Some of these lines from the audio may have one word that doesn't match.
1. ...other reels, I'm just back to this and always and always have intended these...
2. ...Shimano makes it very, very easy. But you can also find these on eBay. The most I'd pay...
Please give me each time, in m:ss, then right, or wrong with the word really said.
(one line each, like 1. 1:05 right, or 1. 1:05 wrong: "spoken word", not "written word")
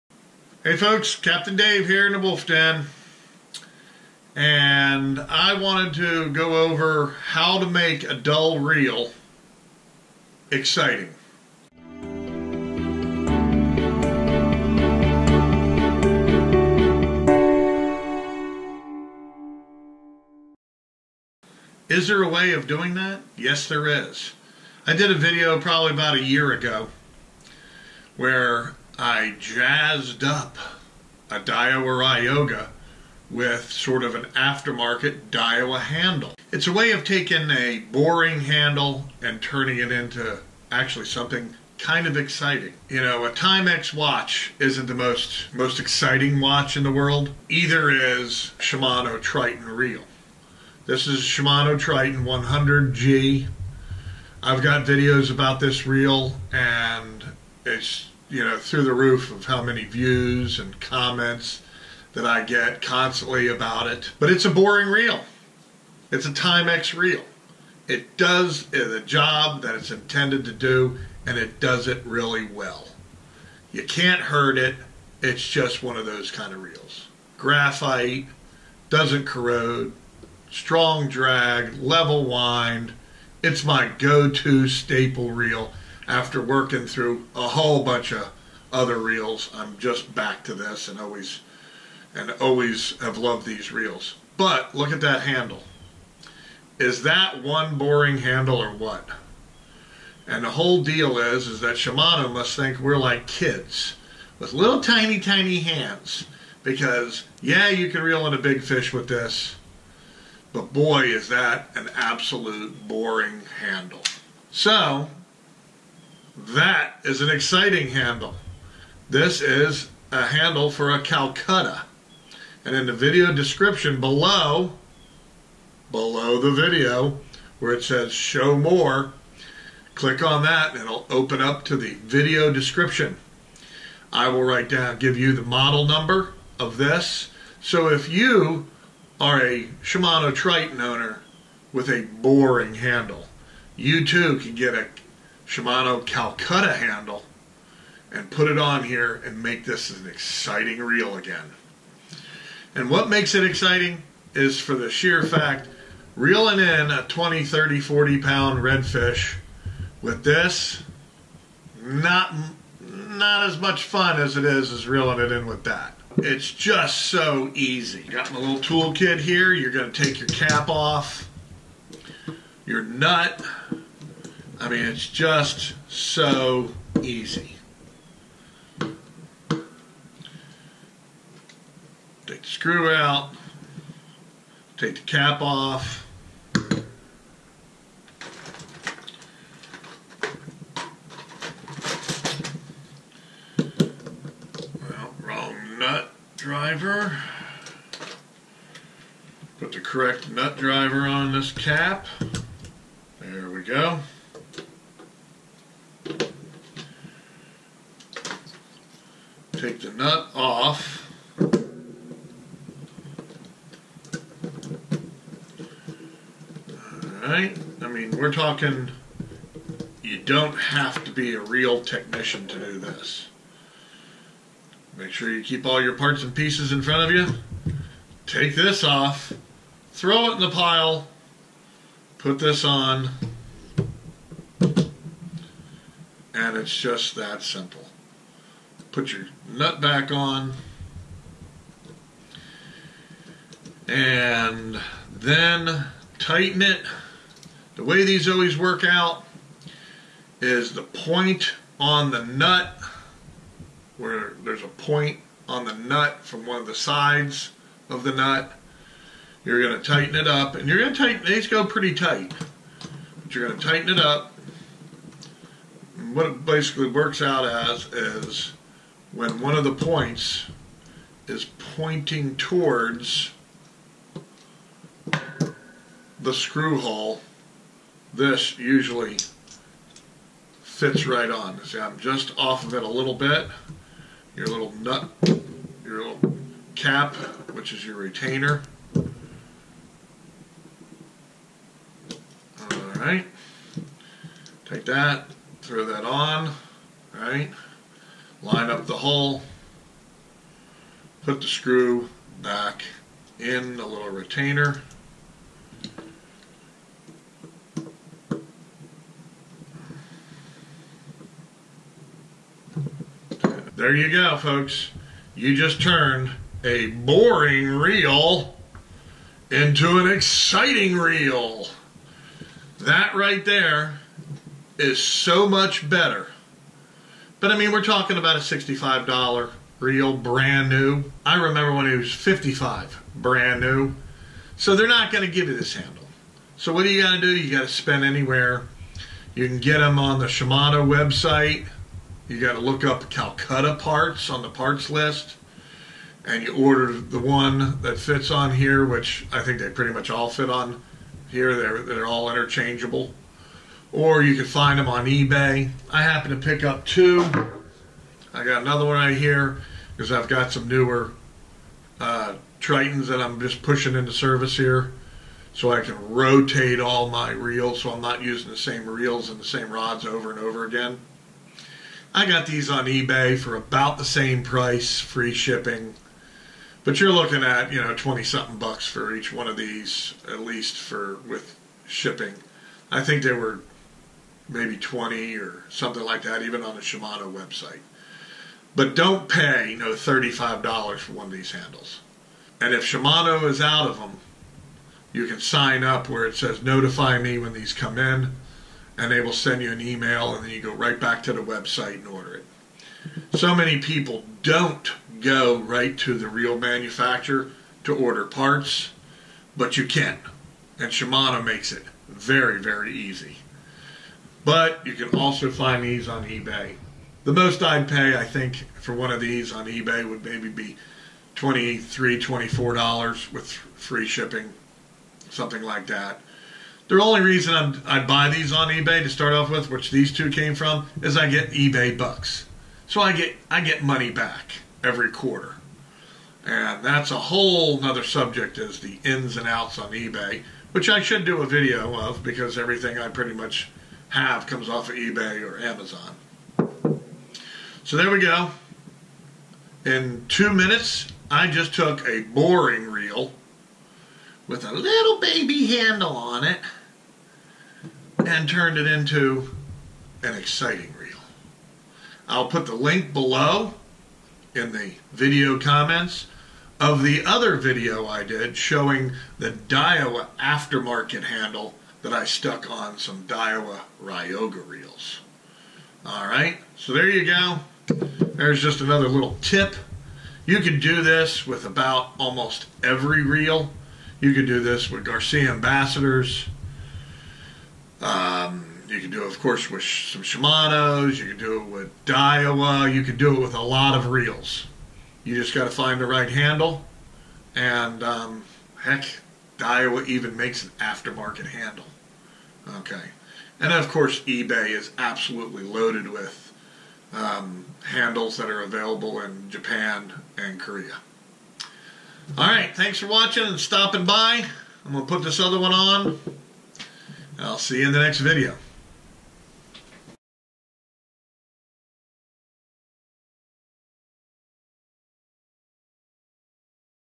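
1. 1:28 wrong: "loved", not "intended"
2. 6:50 right.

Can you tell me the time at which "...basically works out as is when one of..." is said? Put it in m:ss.
4:26.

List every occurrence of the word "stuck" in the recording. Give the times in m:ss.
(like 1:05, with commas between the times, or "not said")
7:52.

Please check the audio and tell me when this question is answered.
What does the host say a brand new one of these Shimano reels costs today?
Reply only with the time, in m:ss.
5:28.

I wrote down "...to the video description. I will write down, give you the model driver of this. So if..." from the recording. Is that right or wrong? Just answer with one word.
wrong.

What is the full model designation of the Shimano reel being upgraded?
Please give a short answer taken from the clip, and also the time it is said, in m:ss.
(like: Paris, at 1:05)
Triton 100G, at 0:51.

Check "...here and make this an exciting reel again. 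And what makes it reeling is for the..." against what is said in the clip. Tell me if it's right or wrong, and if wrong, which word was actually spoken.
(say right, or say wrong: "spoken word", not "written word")
wrong: "exciting", not "reeling".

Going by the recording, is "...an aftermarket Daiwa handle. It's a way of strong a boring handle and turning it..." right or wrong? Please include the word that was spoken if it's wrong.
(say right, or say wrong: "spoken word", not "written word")
wrong: "taking", not "strong".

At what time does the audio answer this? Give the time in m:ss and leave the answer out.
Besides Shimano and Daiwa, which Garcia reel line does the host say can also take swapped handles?
8:05.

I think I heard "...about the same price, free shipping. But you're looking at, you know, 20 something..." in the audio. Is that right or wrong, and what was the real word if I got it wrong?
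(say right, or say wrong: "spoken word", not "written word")
right.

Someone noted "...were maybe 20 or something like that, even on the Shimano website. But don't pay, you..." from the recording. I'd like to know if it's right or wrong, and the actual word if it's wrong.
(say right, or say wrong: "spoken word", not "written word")
right.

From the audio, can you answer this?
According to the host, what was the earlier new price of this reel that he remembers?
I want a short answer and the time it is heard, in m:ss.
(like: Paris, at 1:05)
55, at 5:32.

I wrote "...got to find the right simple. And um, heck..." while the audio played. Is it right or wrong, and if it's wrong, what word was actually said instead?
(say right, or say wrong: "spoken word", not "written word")
wrong: "handle", not "simple".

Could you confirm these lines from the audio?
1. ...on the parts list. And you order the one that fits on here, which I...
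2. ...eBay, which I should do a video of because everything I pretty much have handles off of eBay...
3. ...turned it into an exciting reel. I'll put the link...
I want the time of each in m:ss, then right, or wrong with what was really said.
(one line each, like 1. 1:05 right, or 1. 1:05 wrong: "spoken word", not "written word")
1. 5:44 right
2. 7:19 wrong: "comes", not "handles"
3. 7:38 right.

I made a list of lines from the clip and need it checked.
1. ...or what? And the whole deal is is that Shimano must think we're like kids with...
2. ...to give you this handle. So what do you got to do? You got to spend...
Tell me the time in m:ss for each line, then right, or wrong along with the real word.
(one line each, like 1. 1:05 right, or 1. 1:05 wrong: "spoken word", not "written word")
1. 1:38 right
2. 5:35 right.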